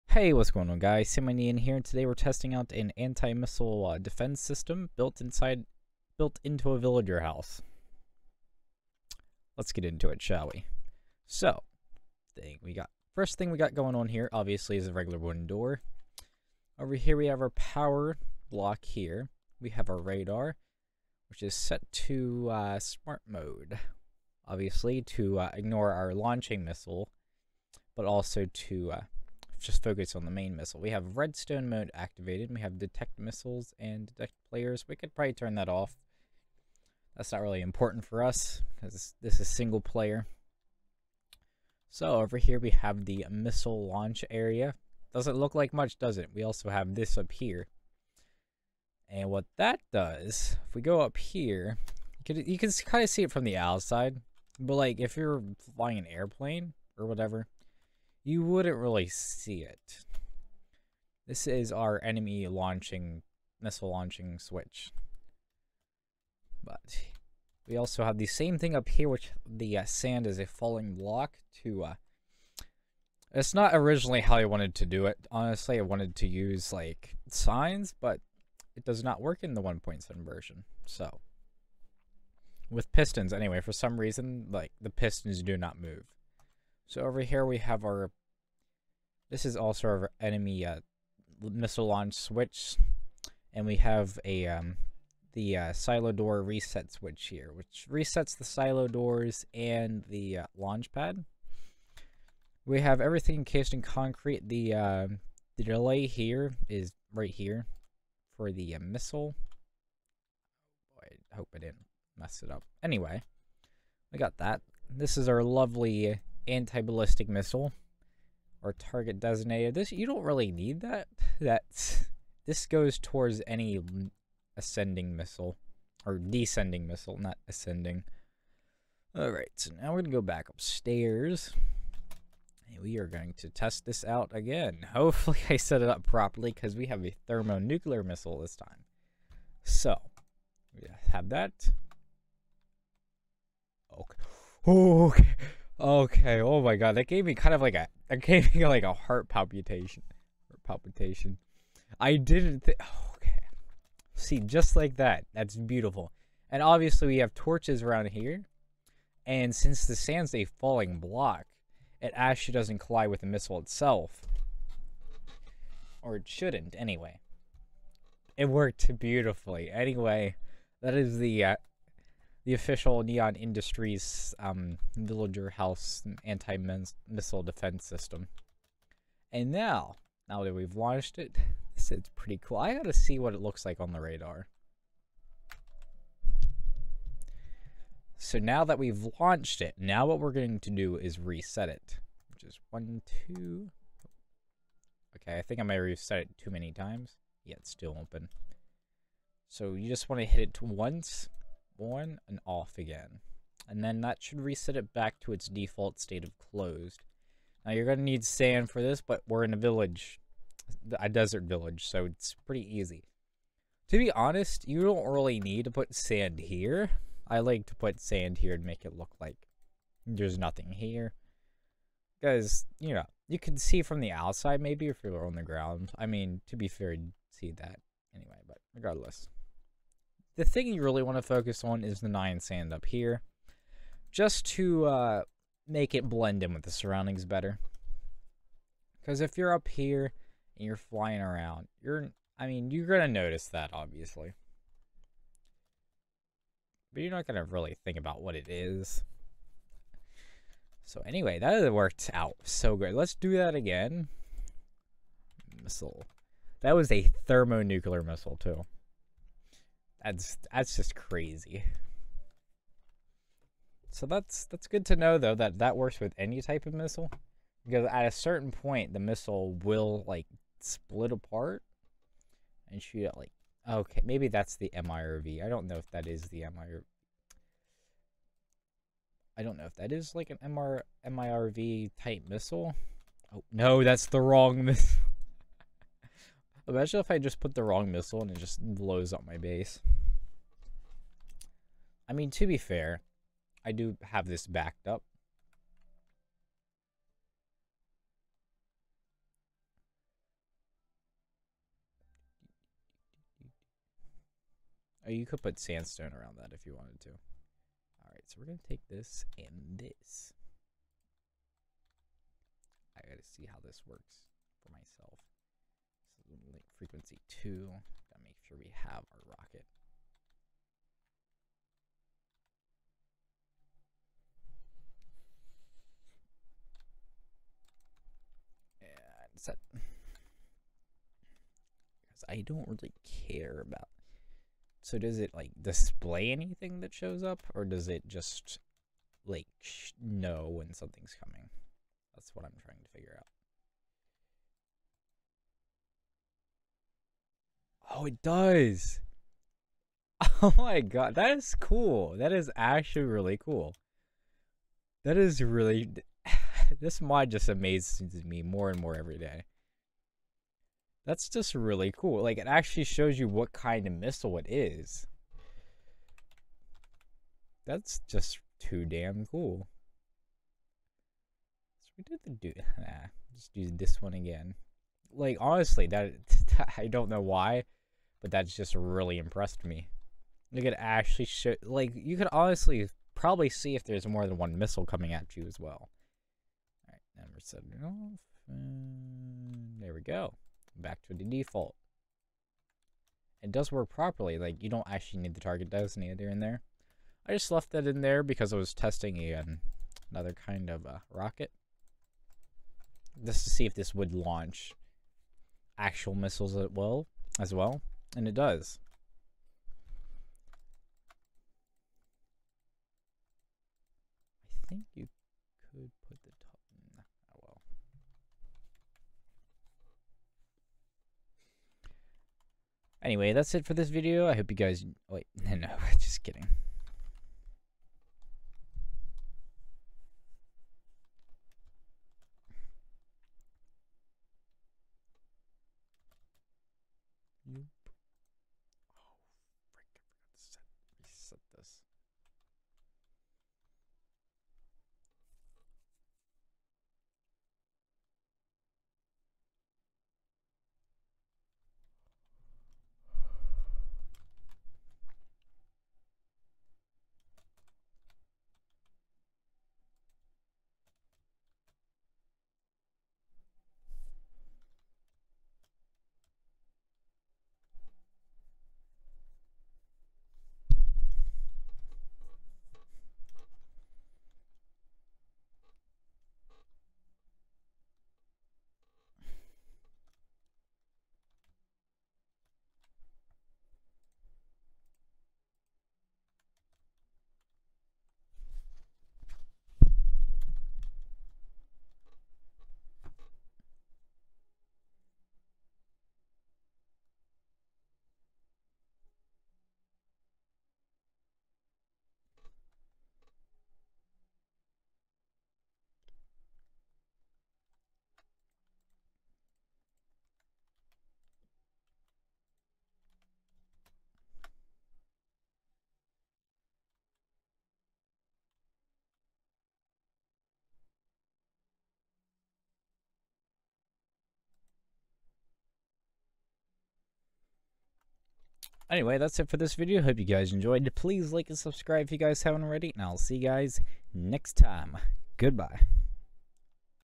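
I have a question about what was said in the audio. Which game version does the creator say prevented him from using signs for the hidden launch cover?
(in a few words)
1.7.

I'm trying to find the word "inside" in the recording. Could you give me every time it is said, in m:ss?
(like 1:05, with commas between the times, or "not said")
0:05.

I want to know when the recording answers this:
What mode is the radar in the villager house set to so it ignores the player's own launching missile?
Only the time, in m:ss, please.
0:22.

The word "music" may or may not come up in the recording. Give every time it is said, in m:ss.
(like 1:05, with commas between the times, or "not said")
not said.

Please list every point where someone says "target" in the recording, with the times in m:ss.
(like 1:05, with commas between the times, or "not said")
1:58, 6:35.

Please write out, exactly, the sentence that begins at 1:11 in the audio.
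Uh, it's not originally how I wanted to do it.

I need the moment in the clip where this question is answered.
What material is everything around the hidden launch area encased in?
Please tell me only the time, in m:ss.
1:43.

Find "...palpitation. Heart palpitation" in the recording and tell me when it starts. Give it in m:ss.
2:29.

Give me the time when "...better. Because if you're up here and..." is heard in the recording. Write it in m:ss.
3:57.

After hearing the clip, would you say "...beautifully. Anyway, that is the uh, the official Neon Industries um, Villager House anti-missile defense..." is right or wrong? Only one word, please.
right.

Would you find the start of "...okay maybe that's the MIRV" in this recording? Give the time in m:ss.
4:33.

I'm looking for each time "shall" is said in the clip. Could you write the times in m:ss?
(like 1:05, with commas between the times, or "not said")
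0:10.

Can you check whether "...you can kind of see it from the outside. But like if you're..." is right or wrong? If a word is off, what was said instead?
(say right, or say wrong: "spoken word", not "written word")
right.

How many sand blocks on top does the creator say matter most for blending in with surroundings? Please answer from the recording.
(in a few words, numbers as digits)
9.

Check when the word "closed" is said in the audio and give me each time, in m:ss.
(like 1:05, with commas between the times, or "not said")
3:26.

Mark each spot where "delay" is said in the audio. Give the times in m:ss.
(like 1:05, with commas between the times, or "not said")
1:45.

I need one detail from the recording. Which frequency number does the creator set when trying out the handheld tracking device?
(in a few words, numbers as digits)
2.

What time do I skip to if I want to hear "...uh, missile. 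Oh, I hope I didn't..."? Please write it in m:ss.
1:48.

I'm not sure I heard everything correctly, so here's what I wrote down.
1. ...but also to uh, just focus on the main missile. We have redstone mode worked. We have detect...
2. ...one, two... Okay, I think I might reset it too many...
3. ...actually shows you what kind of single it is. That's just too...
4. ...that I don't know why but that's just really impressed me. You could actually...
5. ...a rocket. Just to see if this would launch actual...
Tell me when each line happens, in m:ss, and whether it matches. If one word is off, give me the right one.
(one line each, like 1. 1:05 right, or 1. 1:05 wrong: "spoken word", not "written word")
1. 0:27 wrong: "activated", not "worked"
2. 3:12 right
3. 6:02 wrong: "missile", not "single"
4. 6:15 right
5. 6:40 right.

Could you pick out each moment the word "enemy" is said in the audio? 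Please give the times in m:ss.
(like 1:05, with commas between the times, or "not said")
1:02, 1:30.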